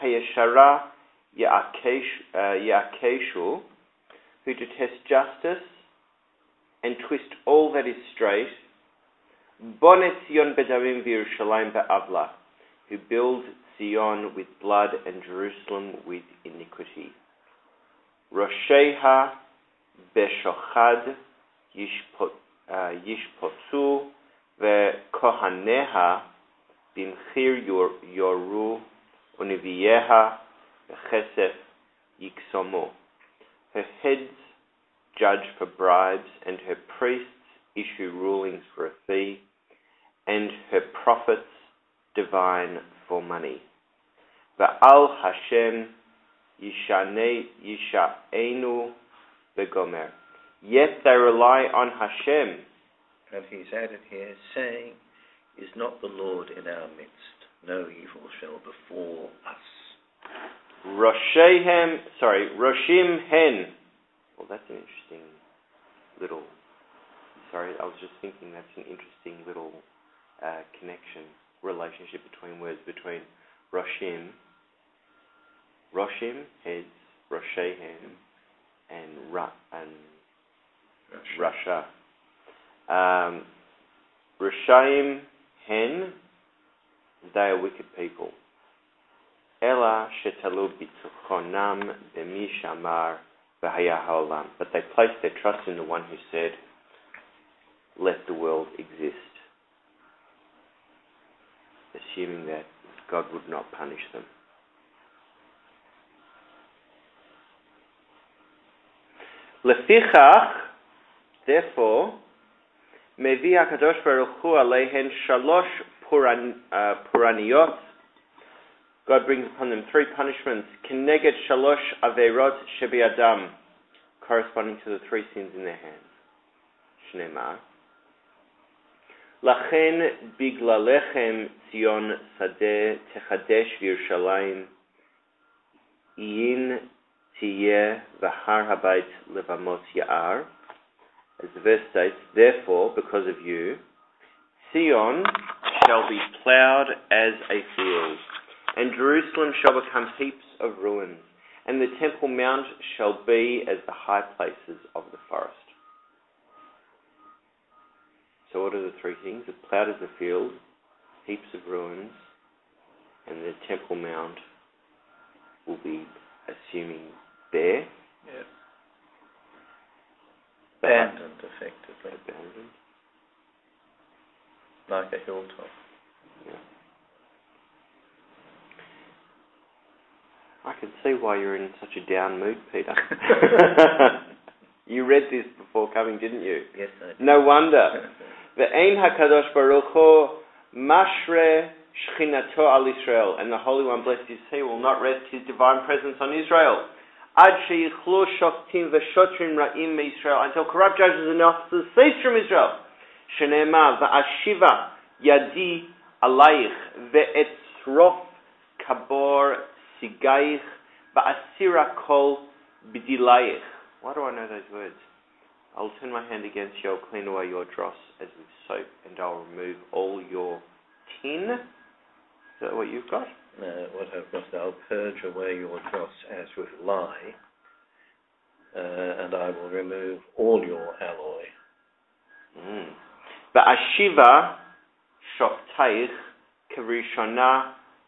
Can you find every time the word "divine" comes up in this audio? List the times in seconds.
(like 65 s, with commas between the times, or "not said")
42 s, 195 s.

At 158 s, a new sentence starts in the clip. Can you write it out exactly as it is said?
So, what are the three things?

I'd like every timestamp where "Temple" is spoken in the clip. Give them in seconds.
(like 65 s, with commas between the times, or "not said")
151 s, 163 s.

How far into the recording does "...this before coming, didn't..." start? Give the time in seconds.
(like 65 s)
185 s.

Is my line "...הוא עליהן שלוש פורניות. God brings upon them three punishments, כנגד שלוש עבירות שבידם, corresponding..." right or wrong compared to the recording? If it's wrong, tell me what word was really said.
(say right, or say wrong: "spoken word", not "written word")
right.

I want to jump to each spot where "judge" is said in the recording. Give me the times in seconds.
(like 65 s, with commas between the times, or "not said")
35 s, 200 s.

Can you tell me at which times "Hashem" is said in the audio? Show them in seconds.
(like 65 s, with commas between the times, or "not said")
45 s, 51 s.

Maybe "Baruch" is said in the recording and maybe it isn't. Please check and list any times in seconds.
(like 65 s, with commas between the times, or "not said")
189 s.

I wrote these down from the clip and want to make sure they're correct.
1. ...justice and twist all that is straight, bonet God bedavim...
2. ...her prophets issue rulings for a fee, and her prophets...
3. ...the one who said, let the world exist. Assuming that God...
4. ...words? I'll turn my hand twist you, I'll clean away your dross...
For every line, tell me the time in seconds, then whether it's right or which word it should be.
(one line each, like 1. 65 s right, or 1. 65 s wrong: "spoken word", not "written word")
1. 5 s wrong: "Sion", not "God"
2. 36 s wrong: "priests", not "prophets"
3. 95 s right
4. 214 s wrong: "against", not "twist".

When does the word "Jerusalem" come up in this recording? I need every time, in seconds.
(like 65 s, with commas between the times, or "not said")
15 s, 148 s.